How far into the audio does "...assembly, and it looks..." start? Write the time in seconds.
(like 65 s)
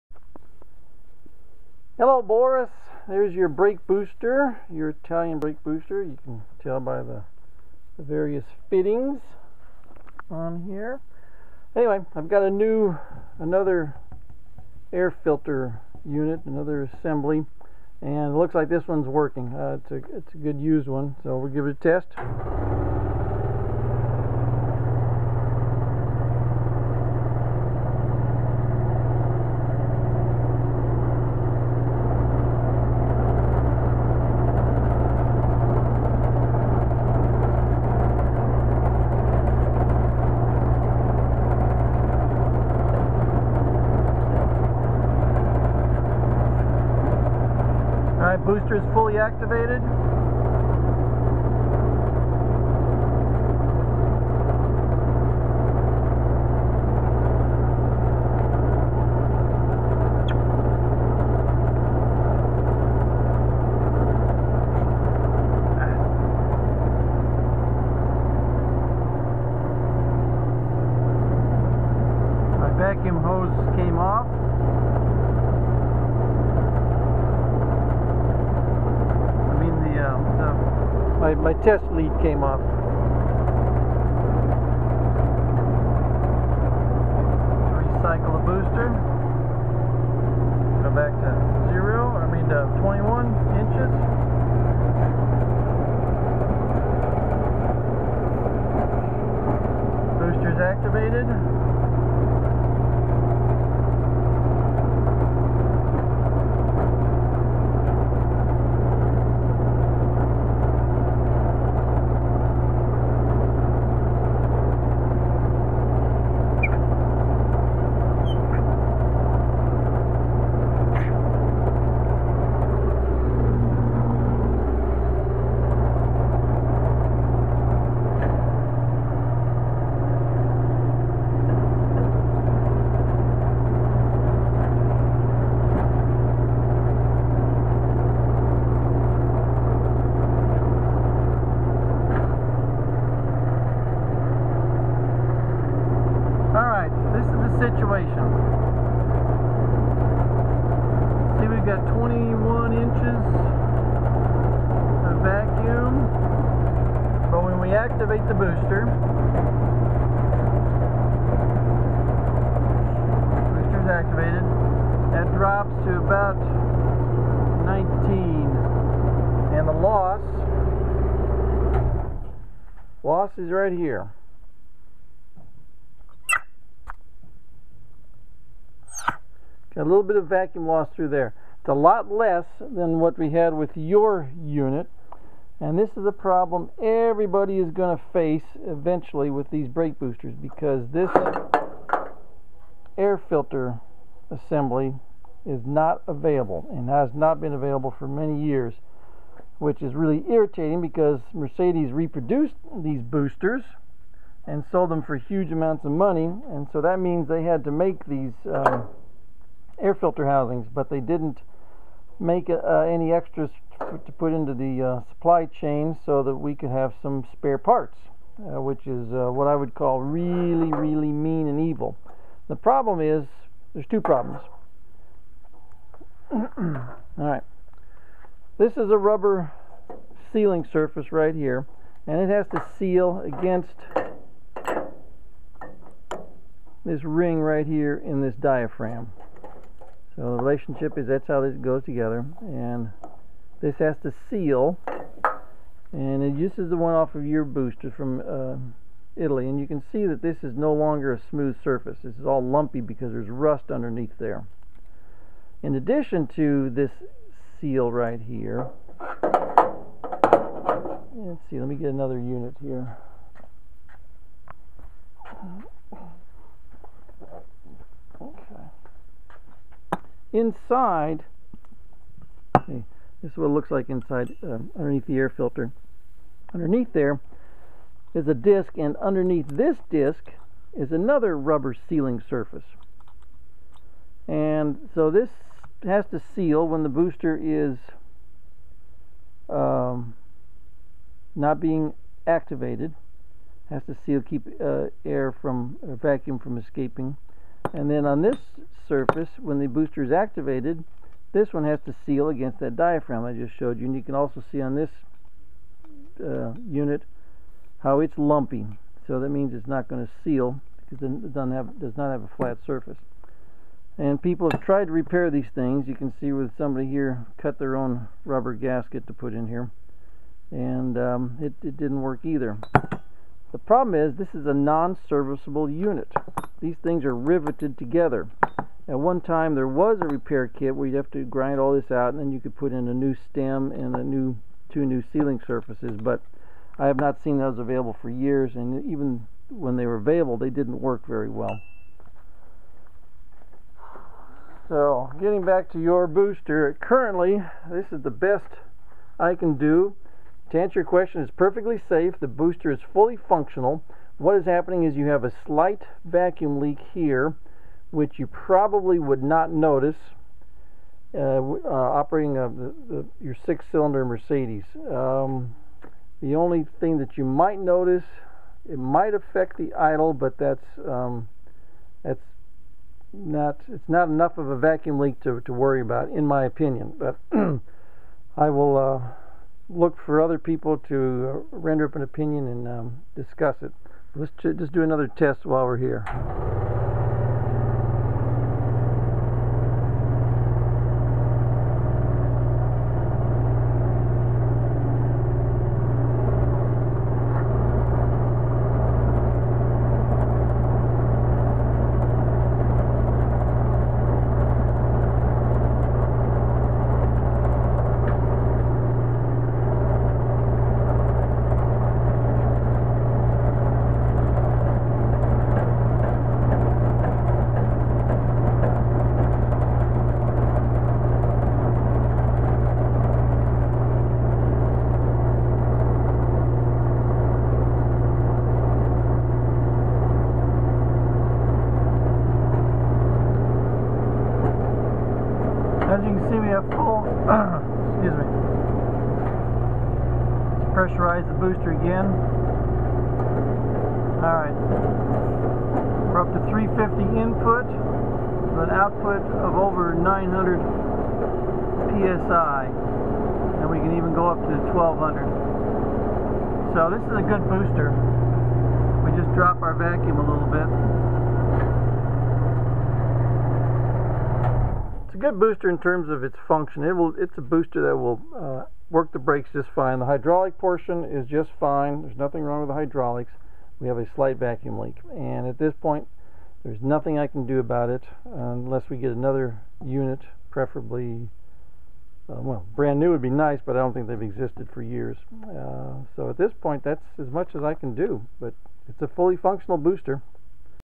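16 s.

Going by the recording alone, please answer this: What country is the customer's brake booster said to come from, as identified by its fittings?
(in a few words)
Italy.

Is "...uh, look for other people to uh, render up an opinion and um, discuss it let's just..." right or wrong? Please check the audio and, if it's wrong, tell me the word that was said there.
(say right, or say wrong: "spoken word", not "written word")
right.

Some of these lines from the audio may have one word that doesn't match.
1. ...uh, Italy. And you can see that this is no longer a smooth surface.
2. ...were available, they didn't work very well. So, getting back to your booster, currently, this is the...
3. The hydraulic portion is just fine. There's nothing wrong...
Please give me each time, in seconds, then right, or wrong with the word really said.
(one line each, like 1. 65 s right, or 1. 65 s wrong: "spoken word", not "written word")
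1. 248 s right
2. 339 s right
3. 469 s right.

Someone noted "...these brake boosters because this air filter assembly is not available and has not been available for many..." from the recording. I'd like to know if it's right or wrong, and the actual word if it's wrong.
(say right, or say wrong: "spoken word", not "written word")
right.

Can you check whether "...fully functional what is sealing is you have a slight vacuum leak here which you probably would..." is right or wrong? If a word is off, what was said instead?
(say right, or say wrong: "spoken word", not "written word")
wrong: "happening", not "sealing".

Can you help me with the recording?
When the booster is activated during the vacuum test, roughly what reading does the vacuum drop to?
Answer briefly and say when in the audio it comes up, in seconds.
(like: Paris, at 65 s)
19, at 165 s.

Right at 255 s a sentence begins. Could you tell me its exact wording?
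In addition to this seal right here, let's see, let me get another unit here.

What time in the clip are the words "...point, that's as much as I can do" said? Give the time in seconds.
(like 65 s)
486 s.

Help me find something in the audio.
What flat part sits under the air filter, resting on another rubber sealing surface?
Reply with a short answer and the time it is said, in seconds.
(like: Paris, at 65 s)
a disc, at 278 s.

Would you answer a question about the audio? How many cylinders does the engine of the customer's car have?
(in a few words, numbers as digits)
6.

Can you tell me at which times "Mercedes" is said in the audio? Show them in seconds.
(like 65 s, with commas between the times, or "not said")
201 s, 364 s.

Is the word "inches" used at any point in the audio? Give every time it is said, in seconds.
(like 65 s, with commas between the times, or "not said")
93 s, 152 s.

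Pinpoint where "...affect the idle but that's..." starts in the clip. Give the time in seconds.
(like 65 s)
369 s.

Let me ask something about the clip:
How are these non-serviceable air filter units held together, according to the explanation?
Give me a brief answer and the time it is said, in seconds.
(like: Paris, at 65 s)
riveted, at 327 s.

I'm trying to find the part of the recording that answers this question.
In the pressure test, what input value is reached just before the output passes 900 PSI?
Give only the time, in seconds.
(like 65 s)
446 s.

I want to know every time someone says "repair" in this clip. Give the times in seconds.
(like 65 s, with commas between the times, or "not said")
314 s, 330 s.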